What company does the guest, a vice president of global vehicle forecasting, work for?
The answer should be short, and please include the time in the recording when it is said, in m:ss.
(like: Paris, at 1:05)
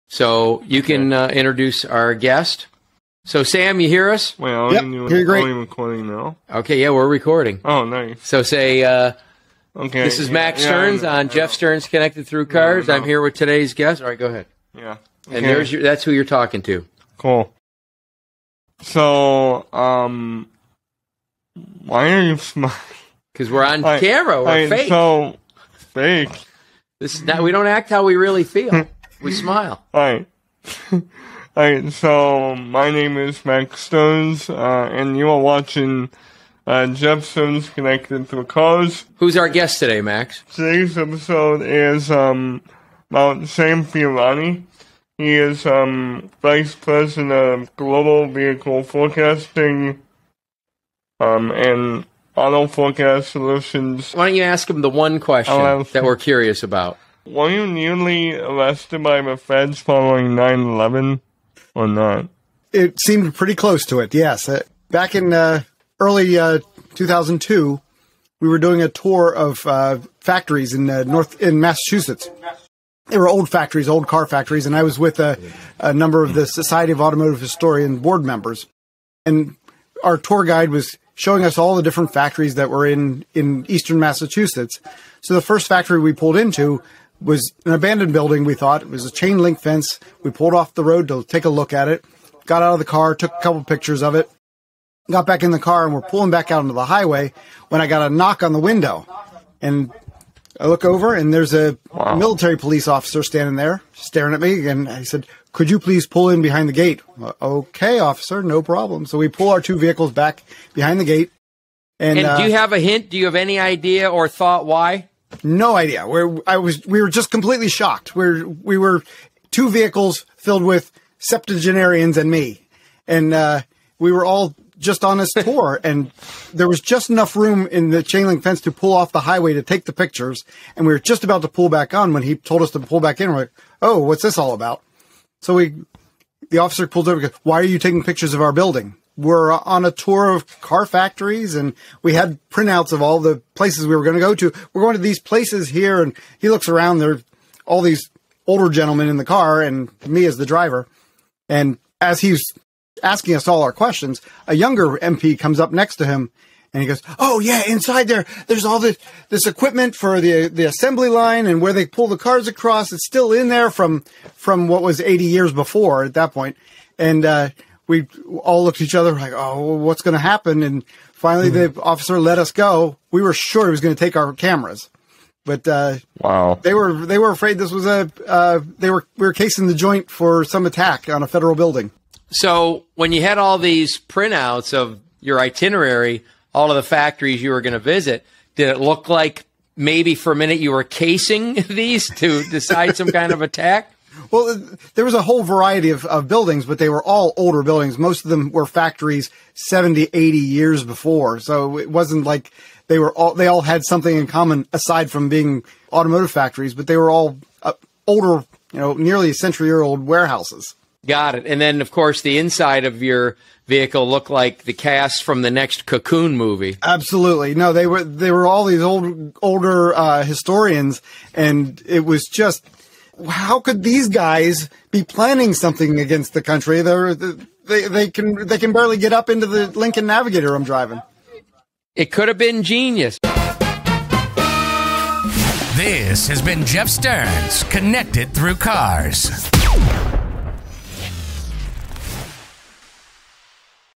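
AutoForecast Solutions, at 0:52.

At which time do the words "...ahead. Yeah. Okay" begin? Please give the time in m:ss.
0:14.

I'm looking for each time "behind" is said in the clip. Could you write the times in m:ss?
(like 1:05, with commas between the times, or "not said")
1:46, 1:50.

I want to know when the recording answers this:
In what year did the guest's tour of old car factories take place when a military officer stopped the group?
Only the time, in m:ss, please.
1:06.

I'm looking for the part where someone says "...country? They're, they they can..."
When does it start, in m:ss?
3:46.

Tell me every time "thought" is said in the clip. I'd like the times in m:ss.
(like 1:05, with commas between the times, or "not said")
1:28, 1:54.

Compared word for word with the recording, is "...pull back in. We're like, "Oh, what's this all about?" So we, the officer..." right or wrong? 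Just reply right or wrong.
right.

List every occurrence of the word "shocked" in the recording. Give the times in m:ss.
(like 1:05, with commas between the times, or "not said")
1:57.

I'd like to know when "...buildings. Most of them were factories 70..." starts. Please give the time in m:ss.
3:17.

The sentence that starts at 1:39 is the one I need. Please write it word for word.
And I look over, and there's a wow.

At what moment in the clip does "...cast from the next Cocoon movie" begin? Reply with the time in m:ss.
3:34.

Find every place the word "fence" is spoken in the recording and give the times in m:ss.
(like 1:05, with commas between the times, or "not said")
1:29, 2:08.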